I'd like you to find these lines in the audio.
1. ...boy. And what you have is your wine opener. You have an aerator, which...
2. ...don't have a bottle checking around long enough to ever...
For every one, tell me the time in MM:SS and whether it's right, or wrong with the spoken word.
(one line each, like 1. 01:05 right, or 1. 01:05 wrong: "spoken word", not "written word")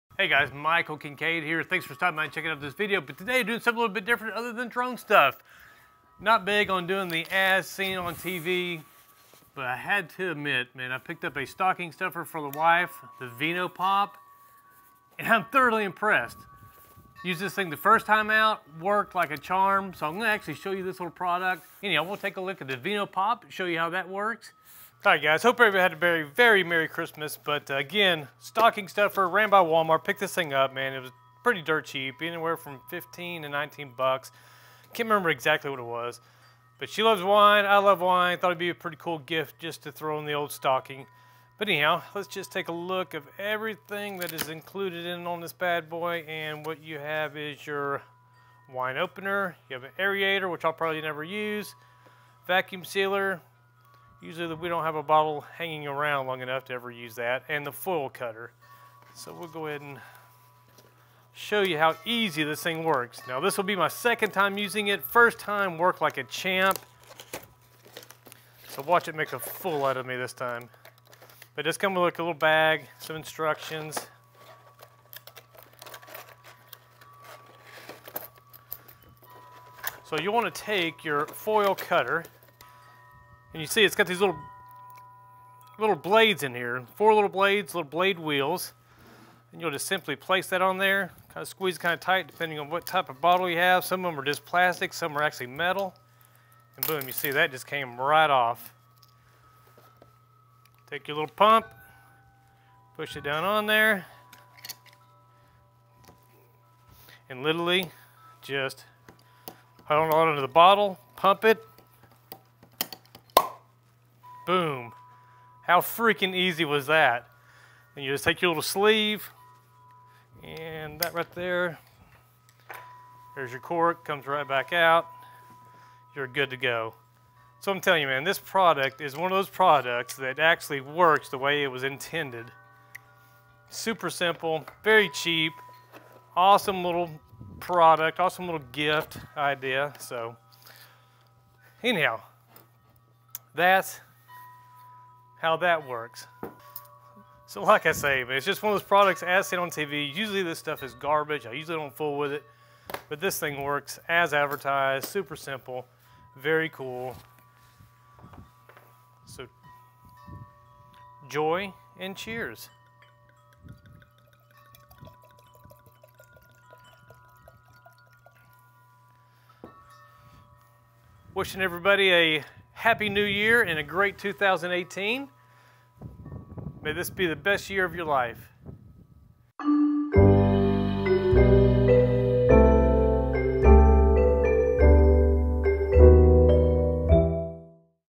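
1. 00:45 right
2. 00:54 wrong: "hanging", not "checking".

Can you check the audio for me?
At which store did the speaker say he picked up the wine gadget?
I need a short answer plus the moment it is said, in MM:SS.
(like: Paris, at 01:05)
Walmart, at 00:29.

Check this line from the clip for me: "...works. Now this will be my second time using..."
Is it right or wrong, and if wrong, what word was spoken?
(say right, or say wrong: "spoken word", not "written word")
right.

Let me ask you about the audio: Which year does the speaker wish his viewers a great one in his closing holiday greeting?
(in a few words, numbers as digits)
2018.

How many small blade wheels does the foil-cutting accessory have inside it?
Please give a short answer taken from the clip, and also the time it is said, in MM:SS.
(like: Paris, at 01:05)
4, at 01:26.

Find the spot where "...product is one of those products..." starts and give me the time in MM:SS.
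02:08.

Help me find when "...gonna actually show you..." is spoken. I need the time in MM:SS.
00:20.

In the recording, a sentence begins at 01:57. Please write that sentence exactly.
And you just take your little sleeve, and that right there, there's your cork, comes right back out.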